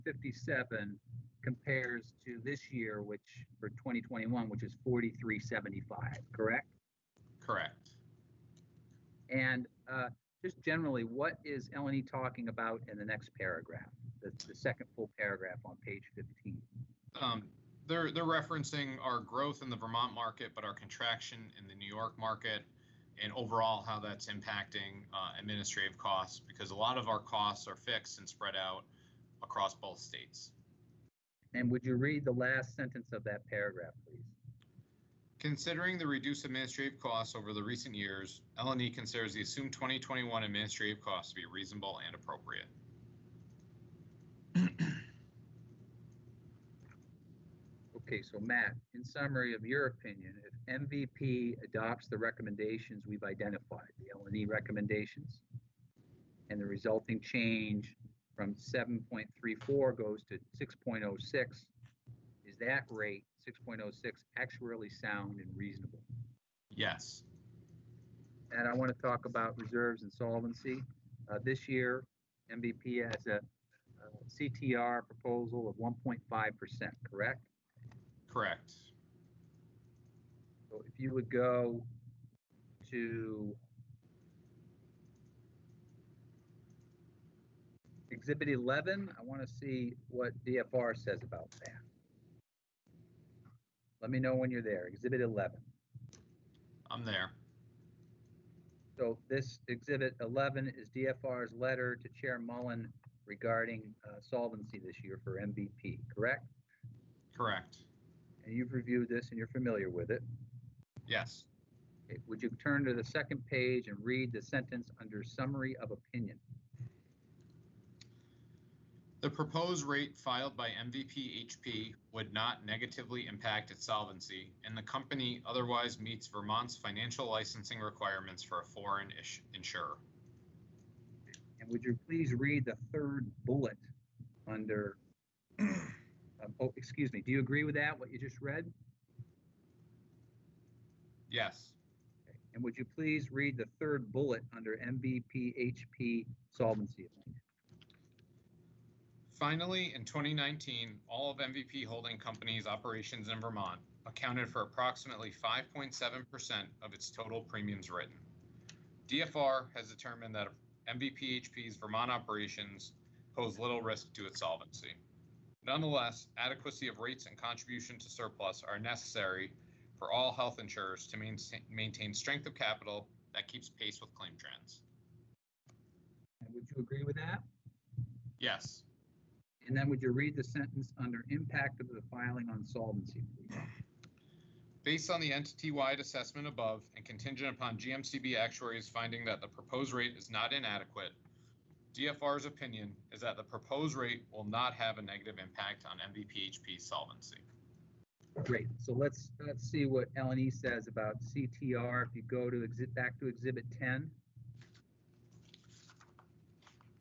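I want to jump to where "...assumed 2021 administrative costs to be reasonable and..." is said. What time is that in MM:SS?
00:39.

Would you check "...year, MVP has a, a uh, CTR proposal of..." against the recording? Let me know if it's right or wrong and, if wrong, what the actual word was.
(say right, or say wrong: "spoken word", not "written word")
right.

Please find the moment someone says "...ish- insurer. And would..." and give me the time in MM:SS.
02:09.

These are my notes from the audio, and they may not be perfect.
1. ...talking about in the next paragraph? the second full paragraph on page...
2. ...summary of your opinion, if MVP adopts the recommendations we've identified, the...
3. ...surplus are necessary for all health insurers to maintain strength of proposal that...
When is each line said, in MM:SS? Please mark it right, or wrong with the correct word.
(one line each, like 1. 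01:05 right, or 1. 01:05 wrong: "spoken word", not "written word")
1. 00:12 right
2. 00:49 right
3. 02:48 wrong: "capital", not "proposal".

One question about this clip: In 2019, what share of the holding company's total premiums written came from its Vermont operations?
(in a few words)
5.7%.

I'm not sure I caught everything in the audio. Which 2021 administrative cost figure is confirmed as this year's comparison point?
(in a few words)
$43.75.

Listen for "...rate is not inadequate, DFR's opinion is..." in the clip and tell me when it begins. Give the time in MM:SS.
03:09.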